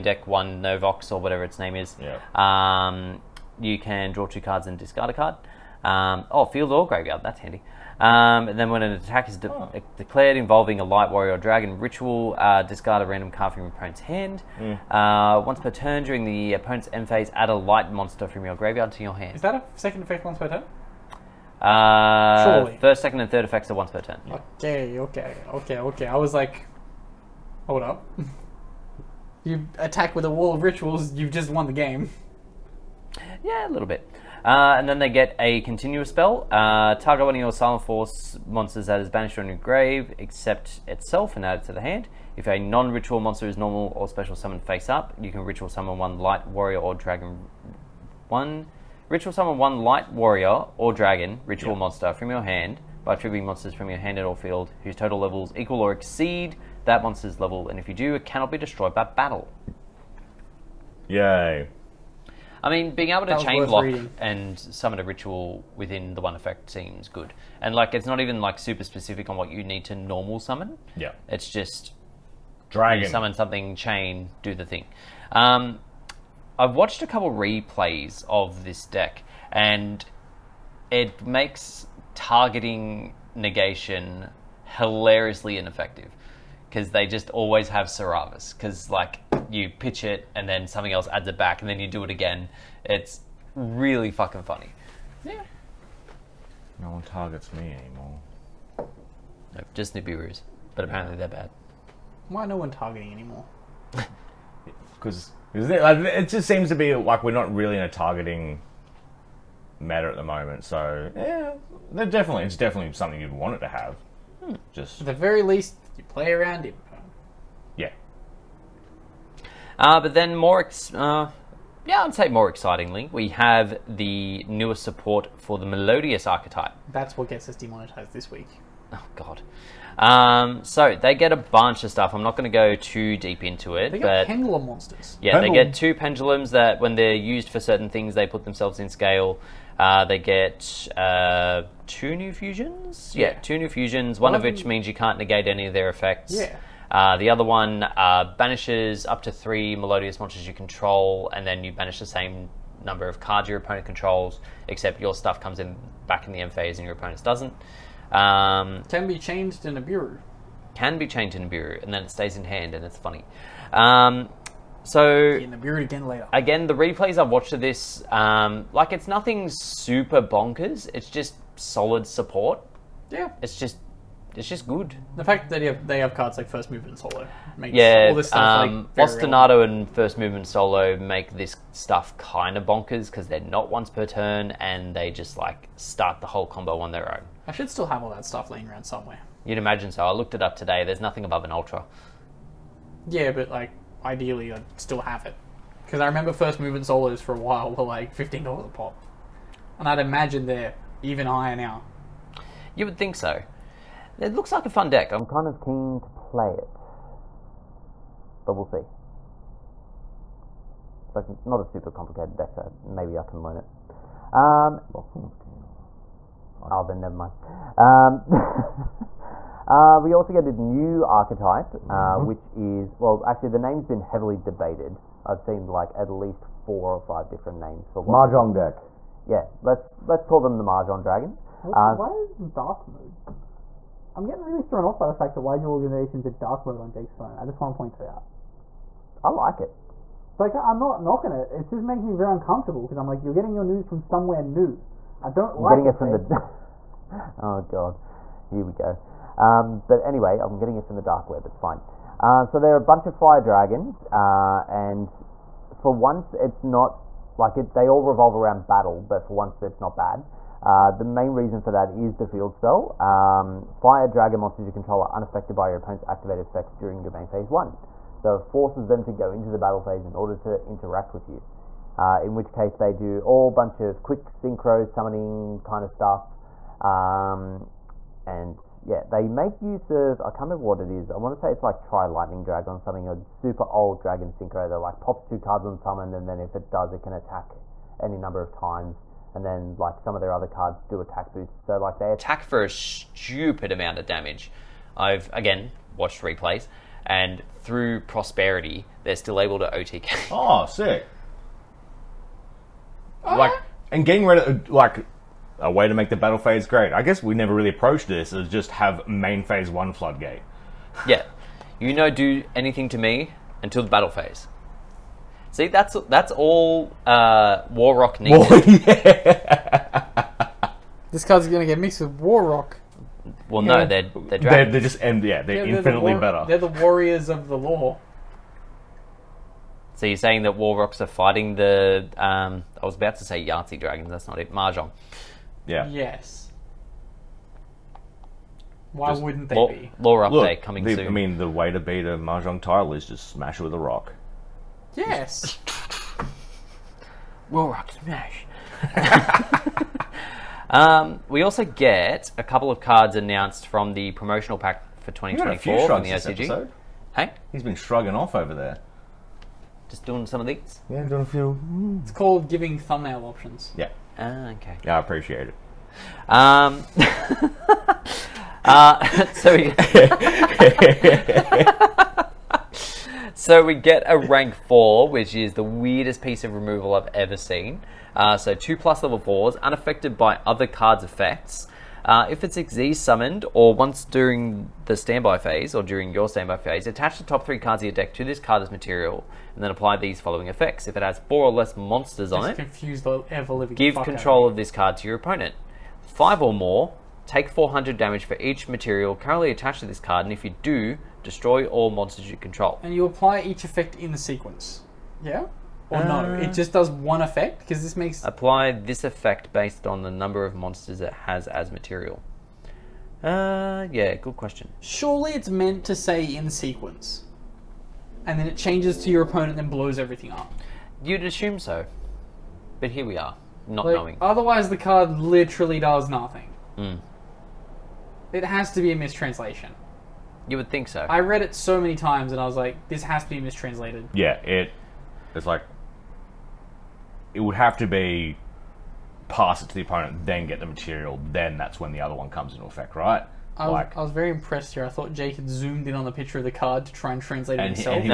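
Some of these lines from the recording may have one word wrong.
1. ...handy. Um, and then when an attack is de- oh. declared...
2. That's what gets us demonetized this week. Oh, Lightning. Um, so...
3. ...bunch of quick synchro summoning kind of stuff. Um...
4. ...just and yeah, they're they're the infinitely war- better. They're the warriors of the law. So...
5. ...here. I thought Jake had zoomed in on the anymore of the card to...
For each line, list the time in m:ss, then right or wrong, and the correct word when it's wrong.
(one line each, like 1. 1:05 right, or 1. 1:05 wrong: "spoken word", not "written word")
1. 0:07 right
2. 2:06 wrong: "God", not "Lightning"
3. 4:33 right
4. 5:24 right
5. 7:24 wrong: "picture", not "anymore".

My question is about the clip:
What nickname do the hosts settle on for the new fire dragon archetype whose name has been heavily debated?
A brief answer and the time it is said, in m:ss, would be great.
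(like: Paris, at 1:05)
Mahjong Dragons, at 3:50.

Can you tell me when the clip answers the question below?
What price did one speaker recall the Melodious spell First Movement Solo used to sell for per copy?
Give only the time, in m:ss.
3:18.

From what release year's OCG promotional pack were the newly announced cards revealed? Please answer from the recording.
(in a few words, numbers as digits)
2024.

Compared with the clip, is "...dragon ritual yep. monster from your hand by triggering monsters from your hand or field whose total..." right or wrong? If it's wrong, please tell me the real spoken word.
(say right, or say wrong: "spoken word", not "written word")
right.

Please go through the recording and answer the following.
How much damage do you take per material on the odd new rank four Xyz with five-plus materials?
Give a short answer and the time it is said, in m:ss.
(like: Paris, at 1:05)
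400, at 6:37.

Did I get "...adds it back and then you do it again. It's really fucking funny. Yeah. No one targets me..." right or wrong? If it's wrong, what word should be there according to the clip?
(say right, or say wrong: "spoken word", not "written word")
right.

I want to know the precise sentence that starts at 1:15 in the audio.
Um, I've watched a couple replays of this deck, and it makes targeting negation hilariously ineffective because they just always have Sauravis.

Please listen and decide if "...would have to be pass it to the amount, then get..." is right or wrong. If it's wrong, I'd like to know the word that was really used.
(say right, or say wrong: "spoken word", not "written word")
wrong: "opponent", not "amount".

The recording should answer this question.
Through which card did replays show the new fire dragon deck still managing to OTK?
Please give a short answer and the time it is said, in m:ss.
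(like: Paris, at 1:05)
Prosperity, at 4:58.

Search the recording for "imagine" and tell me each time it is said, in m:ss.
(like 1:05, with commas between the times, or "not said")
3:09, 3:19.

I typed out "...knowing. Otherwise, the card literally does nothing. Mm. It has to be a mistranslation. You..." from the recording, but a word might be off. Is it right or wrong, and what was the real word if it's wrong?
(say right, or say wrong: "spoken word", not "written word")
right.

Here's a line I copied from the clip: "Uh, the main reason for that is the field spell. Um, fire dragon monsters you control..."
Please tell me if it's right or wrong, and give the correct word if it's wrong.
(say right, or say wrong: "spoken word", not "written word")
right.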